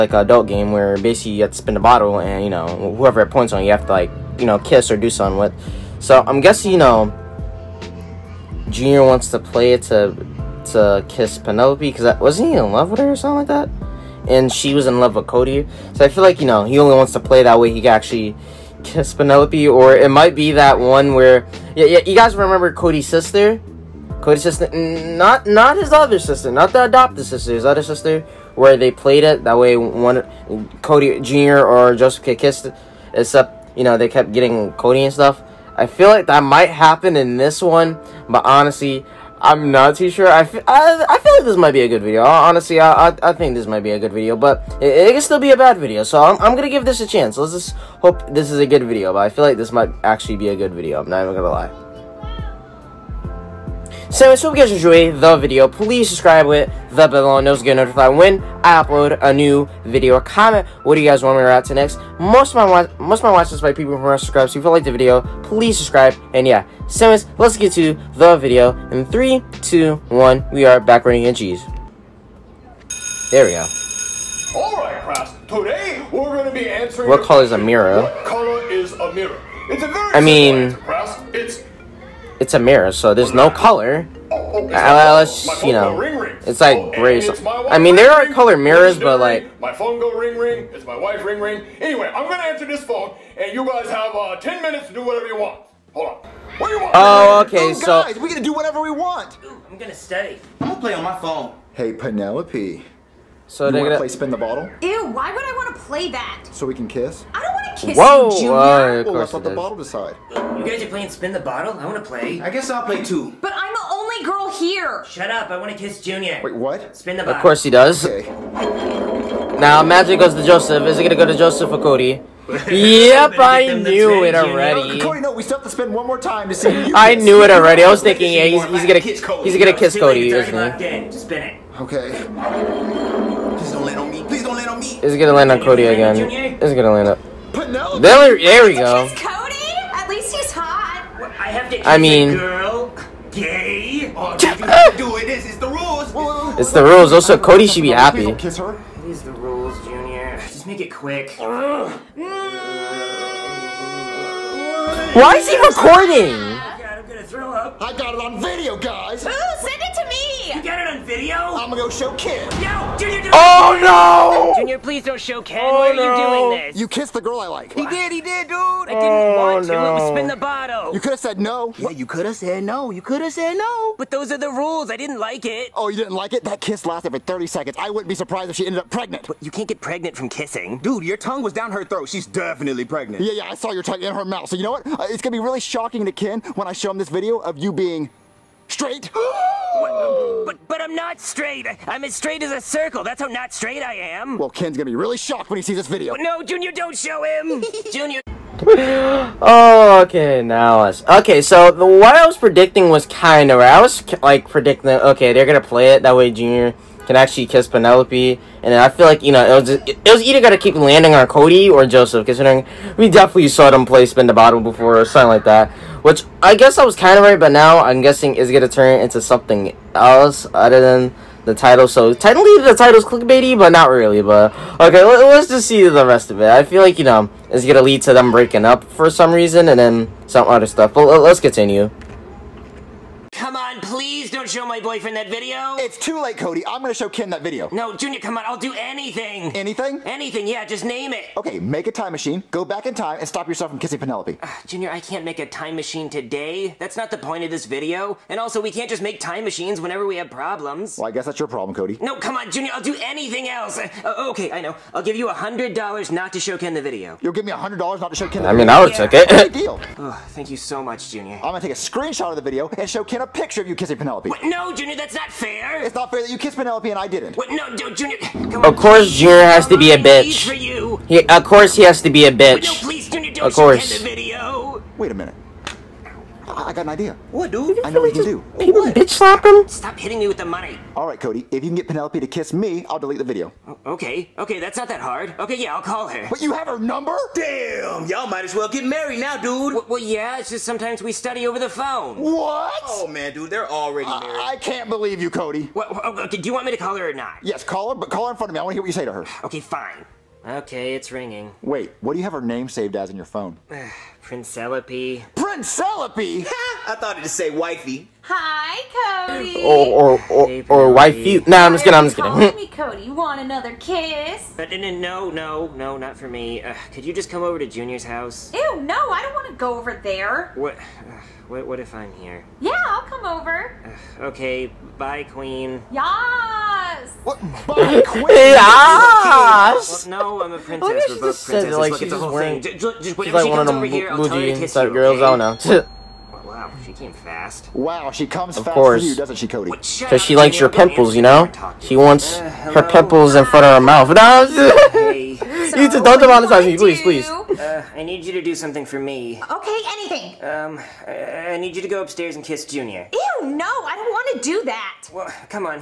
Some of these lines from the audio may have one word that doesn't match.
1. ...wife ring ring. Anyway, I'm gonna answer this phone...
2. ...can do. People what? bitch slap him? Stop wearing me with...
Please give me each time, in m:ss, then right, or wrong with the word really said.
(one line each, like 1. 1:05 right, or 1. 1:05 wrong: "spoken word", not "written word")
1. 1:30 right
2. 4:38 wrong: "hitting", not "wearing".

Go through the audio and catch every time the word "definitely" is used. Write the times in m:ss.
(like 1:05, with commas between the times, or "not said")
3:02, 3:33.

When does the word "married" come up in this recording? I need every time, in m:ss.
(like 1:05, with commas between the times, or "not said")
4:48, 4:54.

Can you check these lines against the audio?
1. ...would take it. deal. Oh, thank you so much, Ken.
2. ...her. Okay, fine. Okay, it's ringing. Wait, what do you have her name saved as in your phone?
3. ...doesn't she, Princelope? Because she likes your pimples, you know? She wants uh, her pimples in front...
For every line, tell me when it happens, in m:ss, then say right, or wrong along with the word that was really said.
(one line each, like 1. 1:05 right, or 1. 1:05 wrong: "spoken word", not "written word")
1. 4:18 wrong: "Junior", not "Ken"
2. 4:59 right
3. 5:39 wrong: "Cody", not "Princelope".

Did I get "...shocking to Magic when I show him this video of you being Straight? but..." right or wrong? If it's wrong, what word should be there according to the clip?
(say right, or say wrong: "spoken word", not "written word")
wrong: "Ken", not "Magic".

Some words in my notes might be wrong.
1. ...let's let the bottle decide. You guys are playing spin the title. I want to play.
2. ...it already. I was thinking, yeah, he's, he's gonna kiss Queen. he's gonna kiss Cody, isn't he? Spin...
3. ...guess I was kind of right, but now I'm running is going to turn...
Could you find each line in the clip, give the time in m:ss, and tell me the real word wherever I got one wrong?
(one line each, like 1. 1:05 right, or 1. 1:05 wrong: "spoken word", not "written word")
1. 1:49 wrong: "bottle", not "title"
2. 2:07 wrong: "Cody", not "Queen"
3. 3:36 wrong: "guessing", not "running".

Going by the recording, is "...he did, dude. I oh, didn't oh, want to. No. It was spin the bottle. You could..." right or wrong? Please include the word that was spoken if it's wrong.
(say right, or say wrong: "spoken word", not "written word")
right.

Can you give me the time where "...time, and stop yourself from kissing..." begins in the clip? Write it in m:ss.
4:02.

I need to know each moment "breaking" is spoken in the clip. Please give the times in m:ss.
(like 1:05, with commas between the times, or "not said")
3:48.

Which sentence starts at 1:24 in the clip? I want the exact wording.
Unless, uh, you know, it's like gray.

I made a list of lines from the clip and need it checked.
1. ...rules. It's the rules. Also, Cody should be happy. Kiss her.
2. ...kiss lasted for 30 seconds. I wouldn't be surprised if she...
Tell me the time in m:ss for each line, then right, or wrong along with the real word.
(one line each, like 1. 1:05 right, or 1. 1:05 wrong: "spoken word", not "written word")
1. 2:25 right
2. 2:56 right.